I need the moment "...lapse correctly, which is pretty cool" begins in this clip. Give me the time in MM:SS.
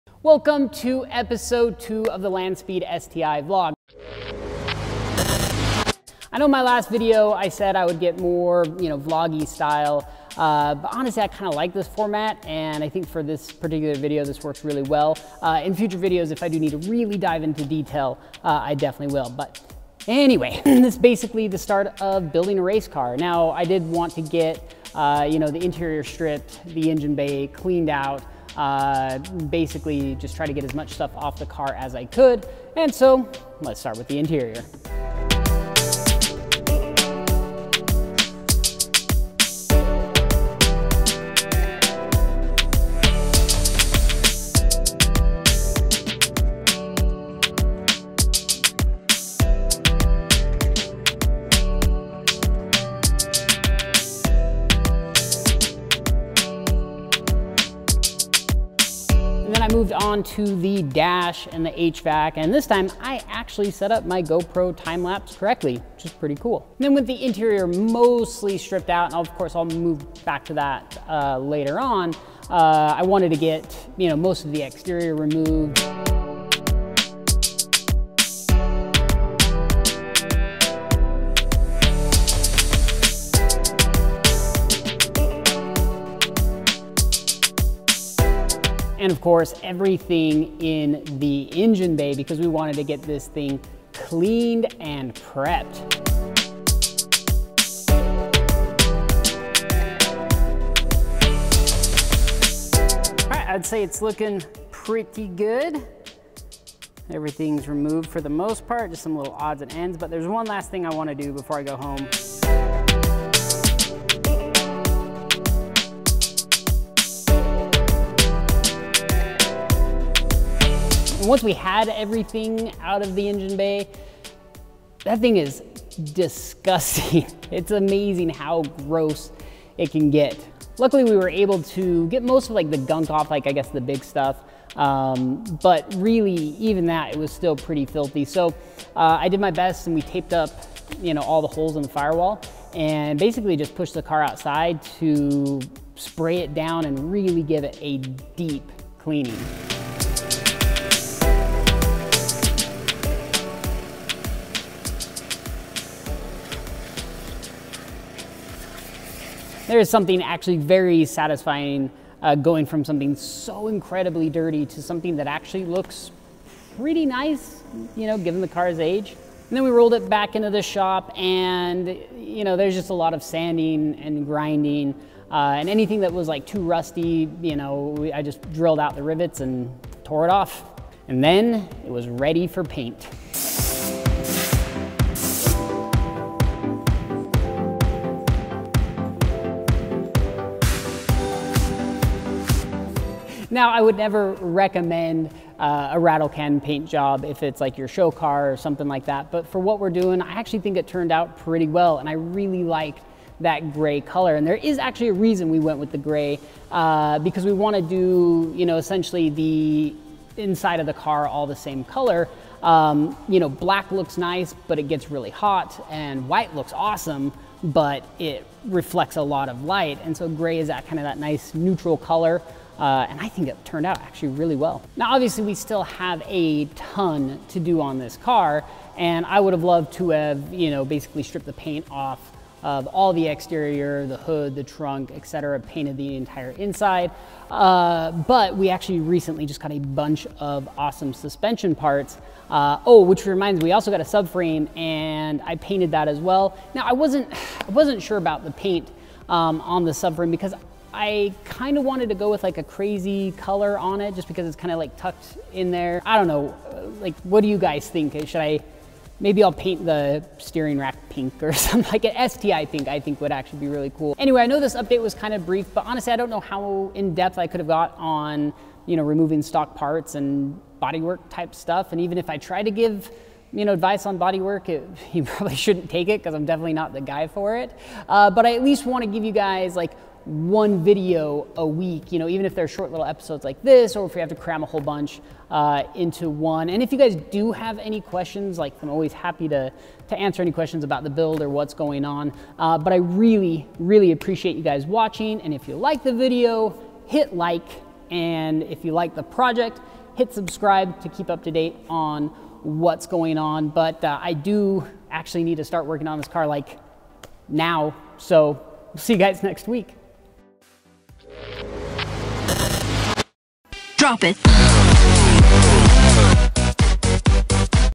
01:05.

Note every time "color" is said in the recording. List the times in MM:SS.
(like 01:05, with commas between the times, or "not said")
03:23, 03:31, 03:41, 04:13.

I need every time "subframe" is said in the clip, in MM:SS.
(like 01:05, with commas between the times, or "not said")
04:04, 04:09.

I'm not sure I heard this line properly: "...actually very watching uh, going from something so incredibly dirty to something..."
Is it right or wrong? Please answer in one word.
wrong.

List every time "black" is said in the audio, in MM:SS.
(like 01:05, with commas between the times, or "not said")
03:33.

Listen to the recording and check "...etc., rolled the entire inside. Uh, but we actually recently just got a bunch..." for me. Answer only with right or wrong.
wrong.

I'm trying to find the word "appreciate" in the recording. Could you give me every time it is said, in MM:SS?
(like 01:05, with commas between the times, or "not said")
04:54.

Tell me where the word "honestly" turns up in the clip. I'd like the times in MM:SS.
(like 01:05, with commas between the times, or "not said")
00:10, 04:25.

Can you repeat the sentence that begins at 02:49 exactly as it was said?
And then we rolled it back into the shop and, you know, there's just a lot of sanding and grinding.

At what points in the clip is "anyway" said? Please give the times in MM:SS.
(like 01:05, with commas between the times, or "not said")
00:20, 04:24.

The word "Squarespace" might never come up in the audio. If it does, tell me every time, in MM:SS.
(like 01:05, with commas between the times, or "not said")
not said.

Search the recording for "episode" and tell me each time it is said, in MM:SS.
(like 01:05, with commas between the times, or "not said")
00:01, 04:43.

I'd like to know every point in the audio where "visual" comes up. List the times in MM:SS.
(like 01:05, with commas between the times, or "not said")
not said.